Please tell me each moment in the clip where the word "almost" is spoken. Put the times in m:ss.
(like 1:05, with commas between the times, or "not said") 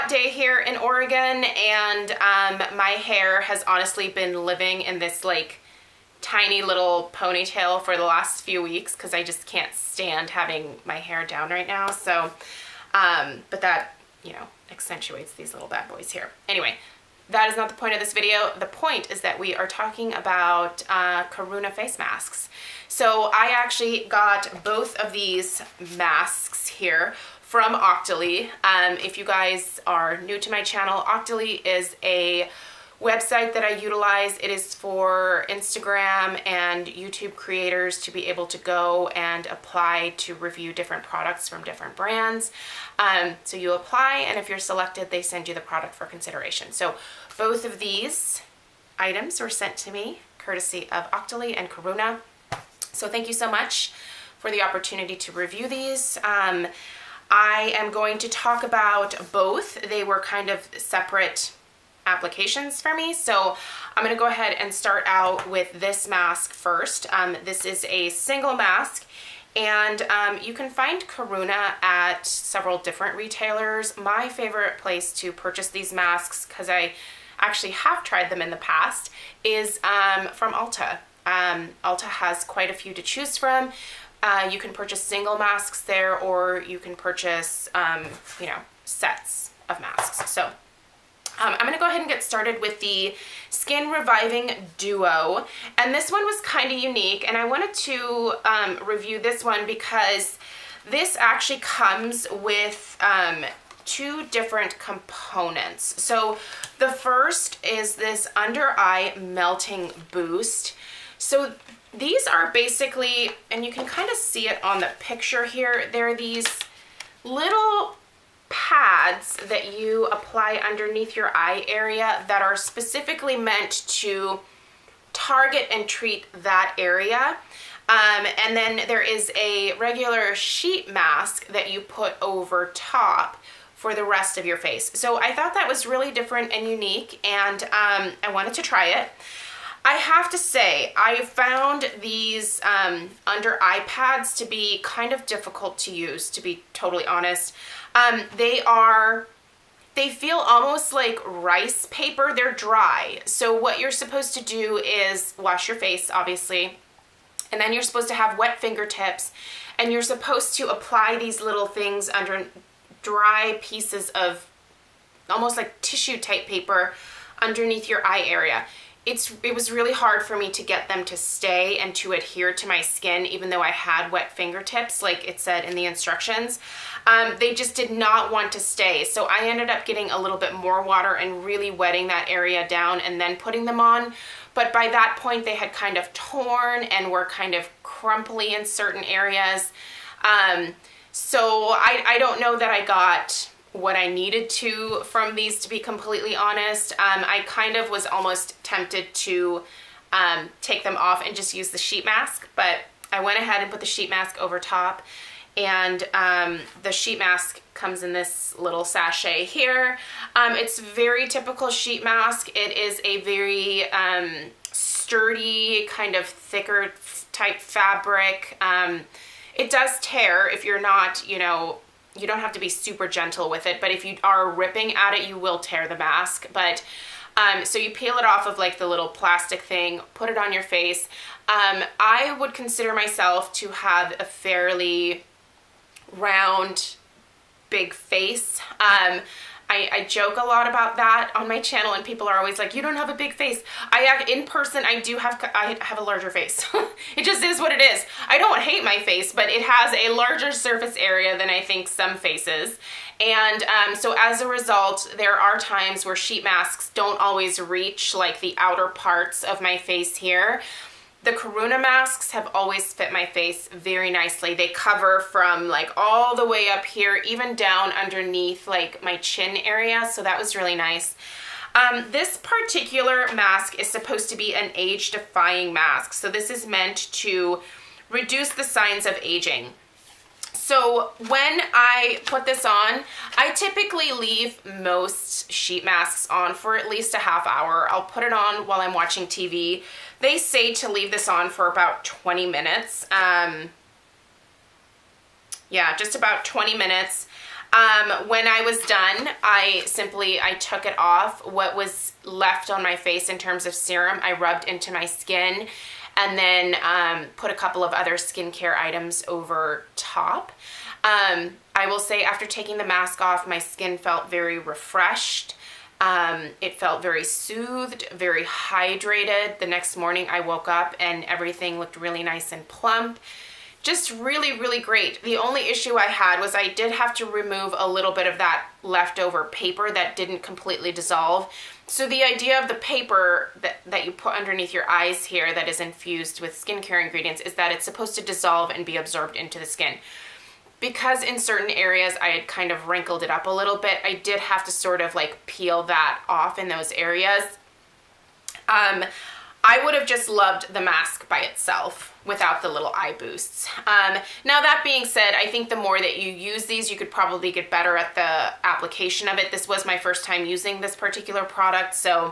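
2:30, 2:45, 3:18.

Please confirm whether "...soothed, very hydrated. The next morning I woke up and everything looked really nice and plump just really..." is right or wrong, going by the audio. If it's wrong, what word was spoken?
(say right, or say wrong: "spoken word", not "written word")
right.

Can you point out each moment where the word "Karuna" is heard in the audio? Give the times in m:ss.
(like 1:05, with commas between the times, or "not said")
0:21, 0:51, 1:11, 4:21.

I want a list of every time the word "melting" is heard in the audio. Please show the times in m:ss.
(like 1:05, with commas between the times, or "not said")
1:49.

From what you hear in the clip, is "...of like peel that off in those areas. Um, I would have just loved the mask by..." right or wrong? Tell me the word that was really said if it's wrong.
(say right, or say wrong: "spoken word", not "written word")
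right.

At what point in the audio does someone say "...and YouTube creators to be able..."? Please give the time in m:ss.
0:36.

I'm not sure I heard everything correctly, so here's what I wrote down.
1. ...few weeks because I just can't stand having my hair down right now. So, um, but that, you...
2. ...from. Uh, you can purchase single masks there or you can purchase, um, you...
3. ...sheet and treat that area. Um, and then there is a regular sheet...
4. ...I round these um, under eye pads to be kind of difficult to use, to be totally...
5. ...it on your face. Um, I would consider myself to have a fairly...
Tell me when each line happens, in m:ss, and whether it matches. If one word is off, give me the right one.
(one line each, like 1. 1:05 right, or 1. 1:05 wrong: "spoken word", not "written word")
1. 0:08 right
2. 1:23 right
3. 2:05 wrong: "target", not "sheet"
4. 2:20 wrong: "found", not "round"
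5. 3:50 right.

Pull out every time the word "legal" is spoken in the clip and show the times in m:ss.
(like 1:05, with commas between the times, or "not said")
not said.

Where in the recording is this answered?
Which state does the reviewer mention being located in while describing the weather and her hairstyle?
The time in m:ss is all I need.
0:00.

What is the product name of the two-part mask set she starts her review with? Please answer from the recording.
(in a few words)
Skin Reviving Duo.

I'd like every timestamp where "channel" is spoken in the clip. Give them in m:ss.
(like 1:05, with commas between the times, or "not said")
0:30, 4:01.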